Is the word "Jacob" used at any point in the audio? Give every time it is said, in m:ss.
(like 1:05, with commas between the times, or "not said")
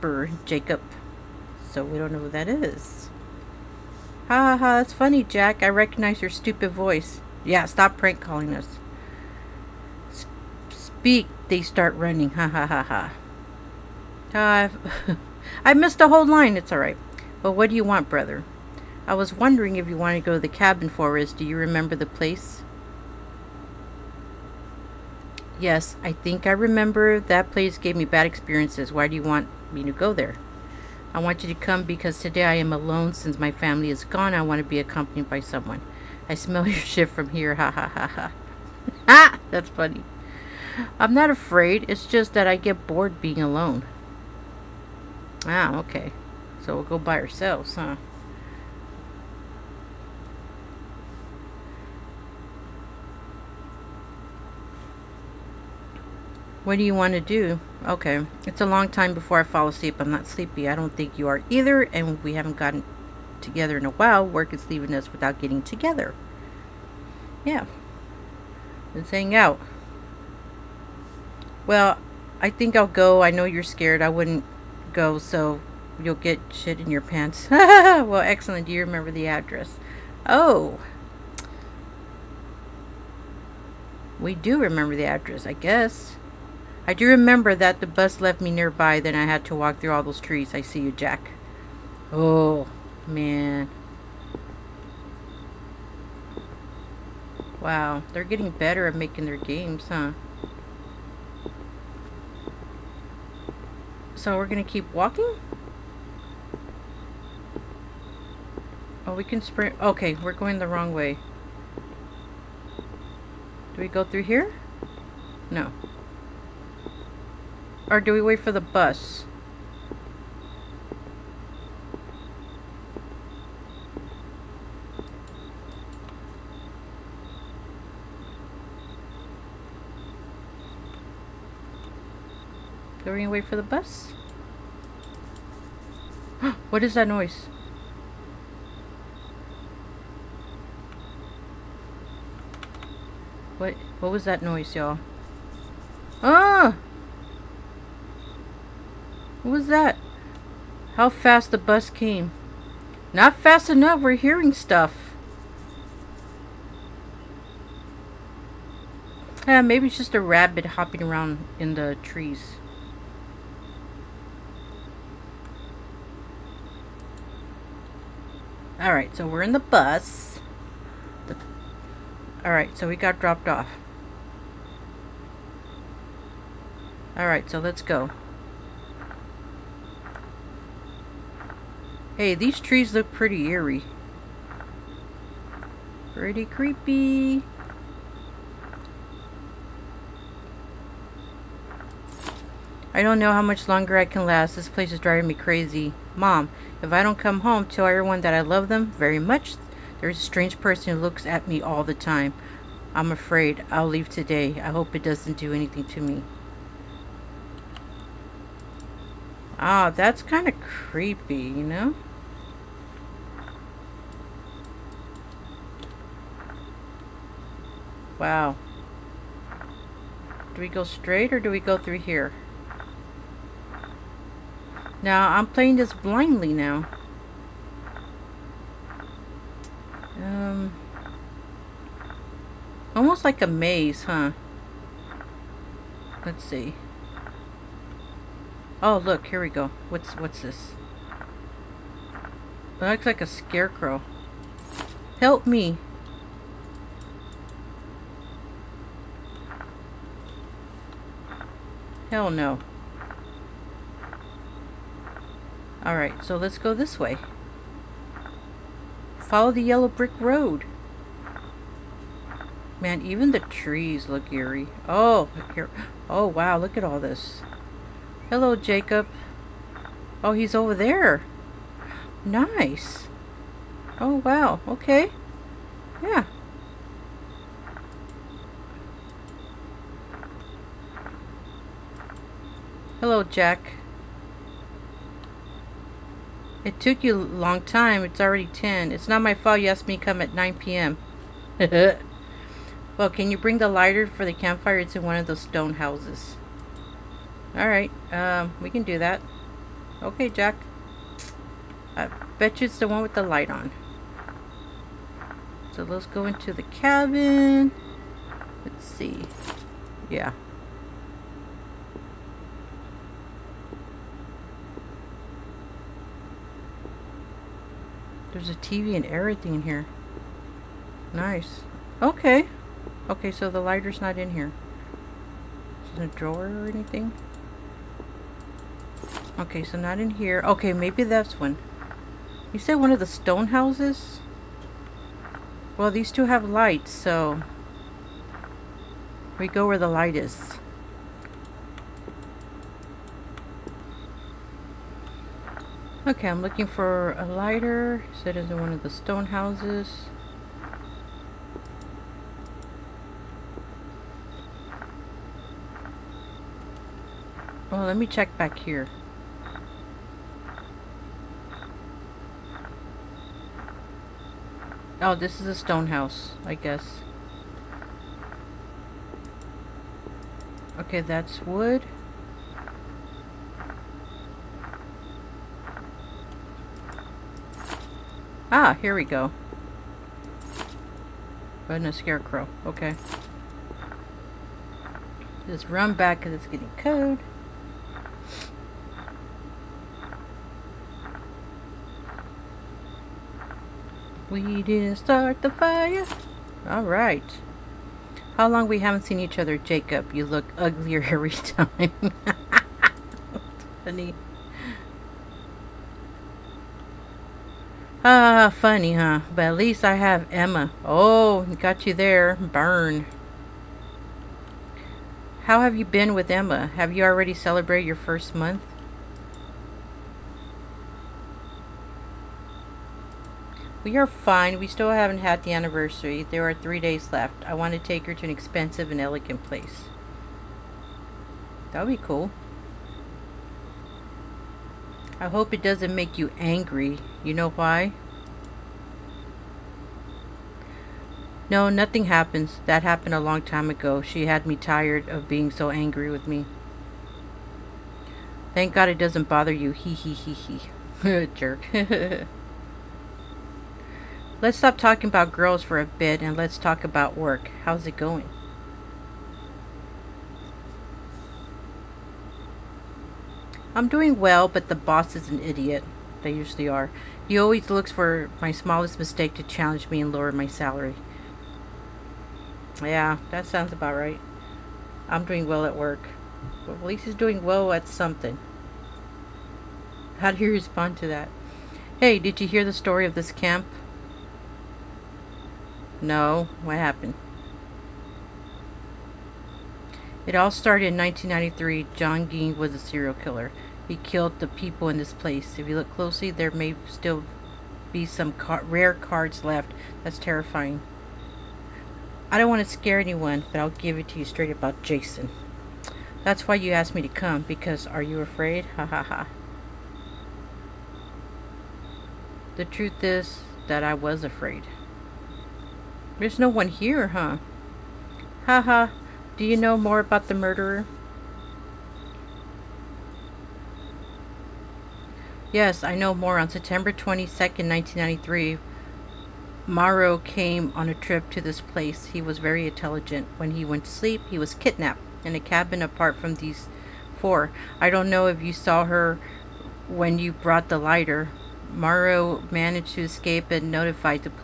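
0:00, 4:28, 6:39.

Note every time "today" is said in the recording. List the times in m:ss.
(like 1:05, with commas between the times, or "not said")
0:32, 3:24.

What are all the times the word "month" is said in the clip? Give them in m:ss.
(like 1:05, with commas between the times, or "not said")
6:58.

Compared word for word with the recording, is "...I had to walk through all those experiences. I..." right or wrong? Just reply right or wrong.
wrong.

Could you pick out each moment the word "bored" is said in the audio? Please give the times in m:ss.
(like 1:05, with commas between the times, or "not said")
0:42.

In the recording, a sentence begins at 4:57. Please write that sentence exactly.
Alright, um, we can do that.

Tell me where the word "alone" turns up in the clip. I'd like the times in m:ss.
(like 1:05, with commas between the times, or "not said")
0:32, 0:43.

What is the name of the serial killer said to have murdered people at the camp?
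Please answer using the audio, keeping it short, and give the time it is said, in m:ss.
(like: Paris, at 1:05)
John Gein, at 8:11.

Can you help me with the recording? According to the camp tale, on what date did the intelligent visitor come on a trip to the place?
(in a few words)
September 22nd.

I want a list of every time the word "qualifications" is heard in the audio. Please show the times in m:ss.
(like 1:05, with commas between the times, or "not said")
not said.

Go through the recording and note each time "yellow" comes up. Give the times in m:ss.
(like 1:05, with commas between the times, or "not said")
4:19.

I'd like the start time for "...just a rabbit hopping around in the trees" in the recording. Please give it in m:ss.
2:39.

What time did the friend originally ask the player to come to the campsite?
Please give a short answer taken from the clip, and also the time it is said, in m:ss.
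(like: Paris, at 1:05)
9 p.m., at 4:50.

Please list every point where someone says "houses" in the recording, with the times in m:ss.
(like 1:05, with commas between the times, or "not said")
4:55, 5:33, 5:49, 6:05.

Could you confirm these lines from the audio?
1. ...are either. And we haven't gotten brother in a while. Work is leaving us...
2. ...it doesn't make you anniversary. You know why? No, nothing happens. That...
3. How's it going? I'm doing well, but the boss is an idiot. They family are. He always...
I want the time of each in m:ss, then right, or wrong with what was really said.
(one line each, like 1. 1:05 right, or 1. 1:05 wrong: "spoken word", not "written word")
1. 1:01 wrong: "together", not "brother"
2. 7:15 wrong: "angry", not "anniversary"
3. 7:37 wrong: "usually", not "family".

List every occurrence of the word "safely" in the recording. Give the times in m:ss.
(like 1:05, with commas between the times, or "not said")
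not said.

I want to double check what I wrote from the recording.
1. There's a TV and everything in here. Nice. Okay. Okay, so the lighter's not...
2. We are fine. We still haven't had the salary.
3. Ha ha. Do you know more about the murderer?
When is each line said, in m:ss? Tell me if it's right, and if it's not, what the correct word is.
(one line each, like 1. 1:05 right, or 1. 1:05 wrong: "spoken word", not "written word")
1. 5:18 right
2. 7:03 wrong: "anniversary", not "salary"
3. 8:38 right.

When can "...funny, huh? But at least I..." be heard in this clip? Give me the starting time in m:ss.
6:48.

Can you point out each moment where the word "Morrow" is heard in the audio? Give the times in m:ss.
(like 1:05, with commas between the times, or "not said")
8:49, 9:01.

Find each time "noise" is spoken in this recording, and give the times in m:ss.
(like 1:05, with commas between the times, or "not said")
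2:17, 2:24.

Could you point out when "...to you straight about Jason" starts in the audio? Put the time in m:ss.
8:24.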